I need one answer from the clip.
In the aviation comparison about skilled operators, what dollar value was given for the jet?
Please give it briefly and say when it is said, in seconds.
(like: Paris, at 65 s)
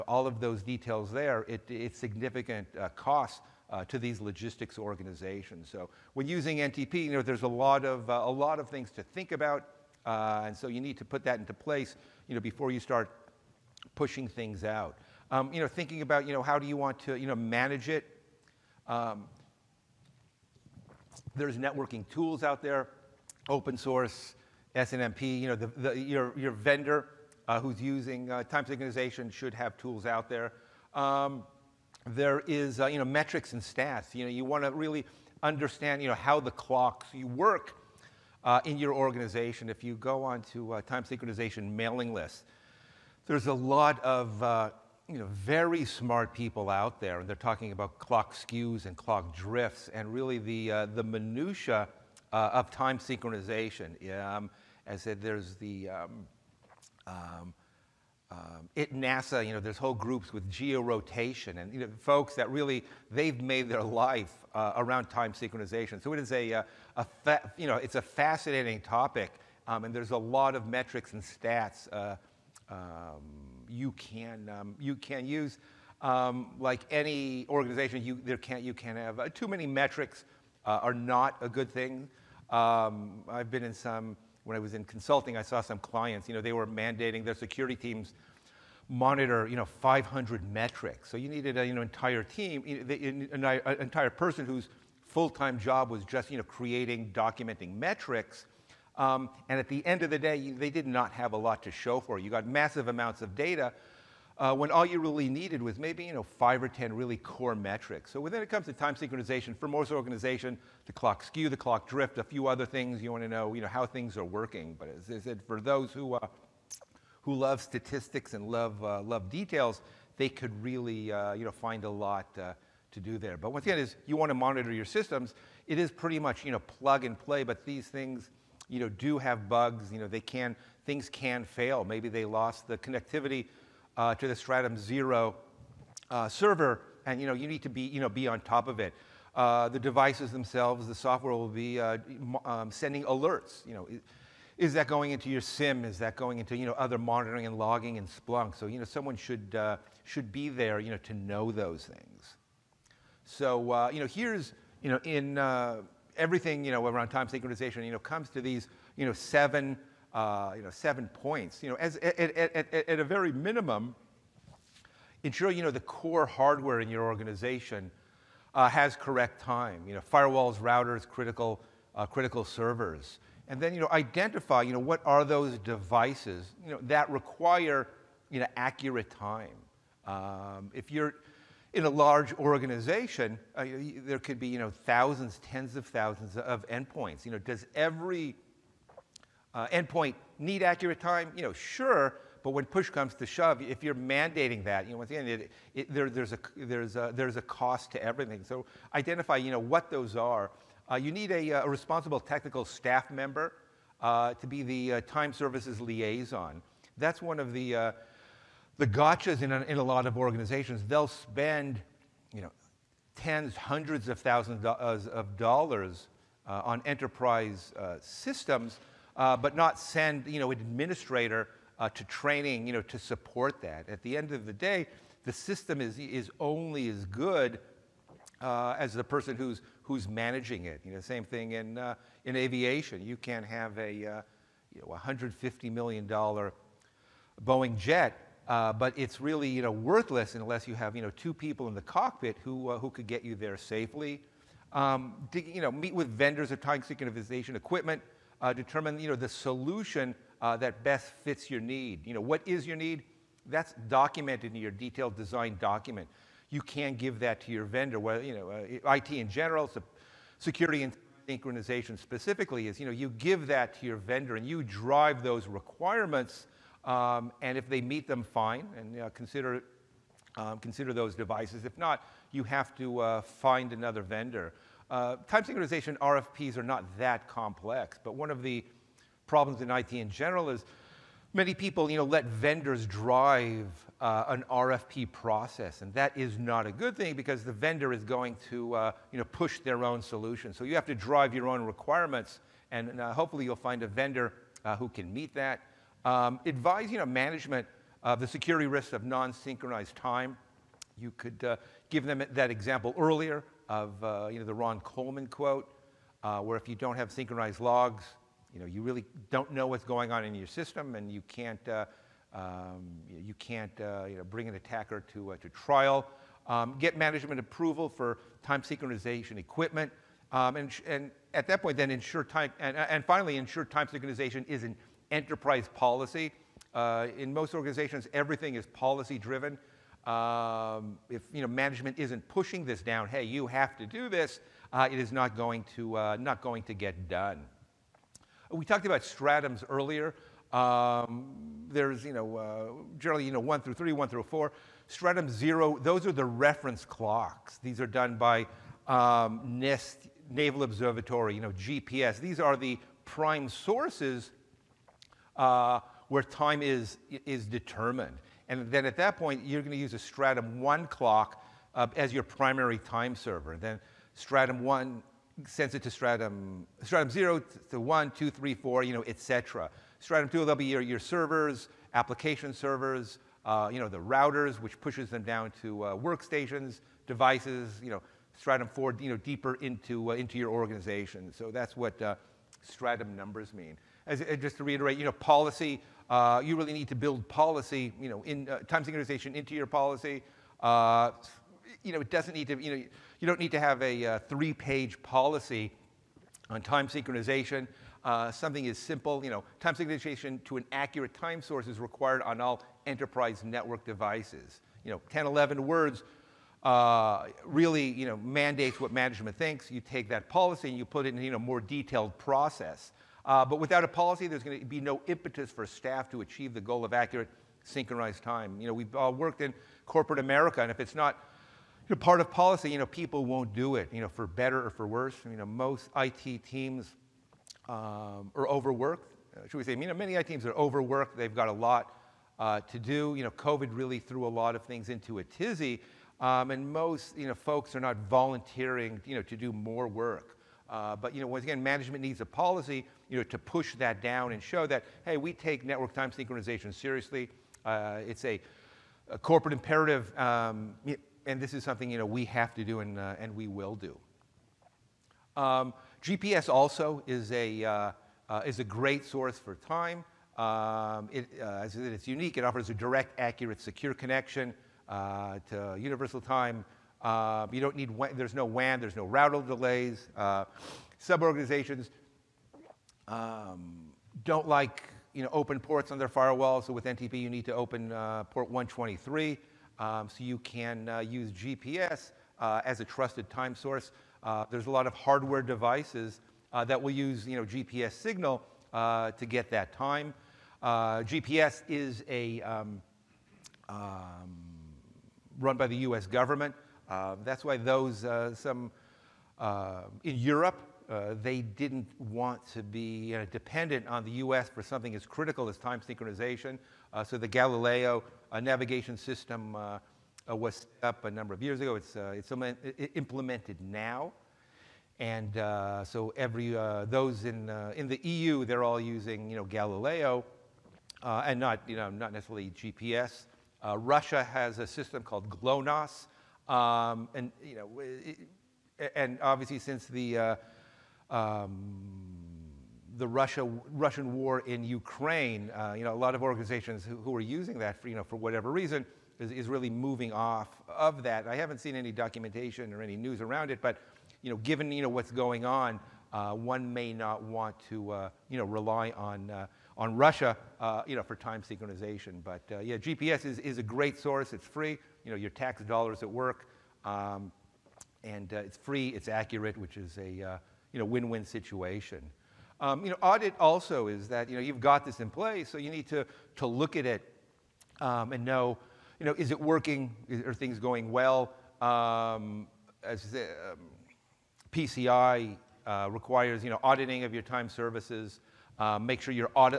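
$150 million, at 234 s.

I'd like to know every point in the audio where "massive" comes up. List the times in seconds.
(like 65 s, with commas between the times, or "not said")
102 s.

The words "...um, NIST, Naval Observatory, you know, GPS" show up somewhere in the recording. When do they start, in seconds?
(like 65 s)
348 s.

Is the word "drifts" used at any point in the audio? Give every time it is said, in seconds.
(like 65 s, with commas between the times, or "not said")
49 s, 111 s.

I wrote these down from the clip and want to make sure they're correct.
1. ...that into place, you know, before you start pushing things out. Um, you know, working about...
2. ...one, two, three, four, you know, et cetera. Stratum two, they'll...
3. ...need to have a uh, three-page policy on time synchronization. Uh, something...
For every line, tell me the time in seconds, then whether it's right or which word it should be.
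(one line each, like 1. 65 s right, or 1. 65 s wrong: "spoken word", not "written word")
1. 11 s wrong: "thinking", not "working"
2. 367 s right
3. 393 s right.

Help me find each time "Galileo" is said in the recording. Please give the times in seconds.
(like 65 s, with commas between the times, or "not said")
507 s, 519 s.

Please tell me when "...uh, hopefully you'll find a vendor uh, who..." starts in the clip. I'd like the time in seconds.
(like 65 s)
293 s.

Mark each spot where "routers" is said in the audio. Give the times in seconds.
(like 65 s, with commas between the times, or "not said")
170 s, 373 s, 469 s.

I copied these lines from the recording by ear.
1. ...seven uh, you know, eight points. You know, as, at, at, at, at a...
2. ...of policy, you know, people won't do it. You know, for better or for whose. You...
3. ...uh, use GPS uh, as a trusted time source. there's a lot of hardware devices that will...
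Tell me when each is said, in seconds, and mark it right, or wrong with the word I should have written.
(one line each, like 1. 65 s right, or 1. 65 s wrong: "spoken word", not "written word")
1. 159 s wrong: "seven", not "eight"
2. 422 s wrong: "worse", not "whose"
3. 480 s right.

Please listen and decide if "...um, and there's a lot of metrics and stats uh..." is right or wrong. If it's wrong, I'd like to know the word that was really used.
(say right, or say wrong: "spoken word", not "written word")
right.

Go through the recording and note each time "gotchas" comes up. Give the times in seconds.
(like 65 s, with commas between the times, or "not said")
208 s.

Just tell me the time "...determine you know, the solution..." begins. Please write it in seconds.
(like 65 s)
248 s.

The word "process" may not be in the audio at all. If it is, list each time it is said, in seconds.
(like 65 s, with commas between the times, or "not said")
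285 s, 412 s.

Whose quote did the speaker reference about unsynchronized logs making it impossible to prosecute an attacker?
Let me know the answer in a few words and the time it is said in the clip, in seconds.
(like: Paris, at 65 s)
Ron Coleman, at 304 s.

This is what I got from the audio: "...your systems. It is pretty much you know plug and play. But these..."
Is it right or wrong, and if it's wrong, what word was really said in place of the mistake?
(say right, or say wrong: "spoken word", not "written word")
right.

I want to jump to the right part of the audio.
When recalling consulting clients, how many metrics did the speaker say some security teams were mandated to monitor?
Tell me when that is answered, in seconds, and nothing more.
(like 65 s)
89 s.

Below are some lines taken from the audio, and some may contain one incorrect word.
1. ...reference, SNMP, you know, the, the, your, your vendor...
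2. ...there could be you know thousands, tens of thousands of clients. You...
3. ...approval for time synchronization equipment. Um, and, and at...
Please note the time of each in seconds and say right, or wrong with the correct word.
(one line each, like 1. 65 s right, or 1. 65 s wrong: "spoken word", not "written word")
1. 23 s wrong: "source", not "reference"
2. 184 s wrong: "endpoints", not "clients"
3. 317 s right.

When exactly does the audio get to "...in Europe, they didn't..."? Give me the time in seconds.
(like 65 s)
500 s.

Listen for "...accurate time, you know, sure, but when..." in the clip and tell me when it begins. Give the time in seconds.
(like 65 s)
190 s.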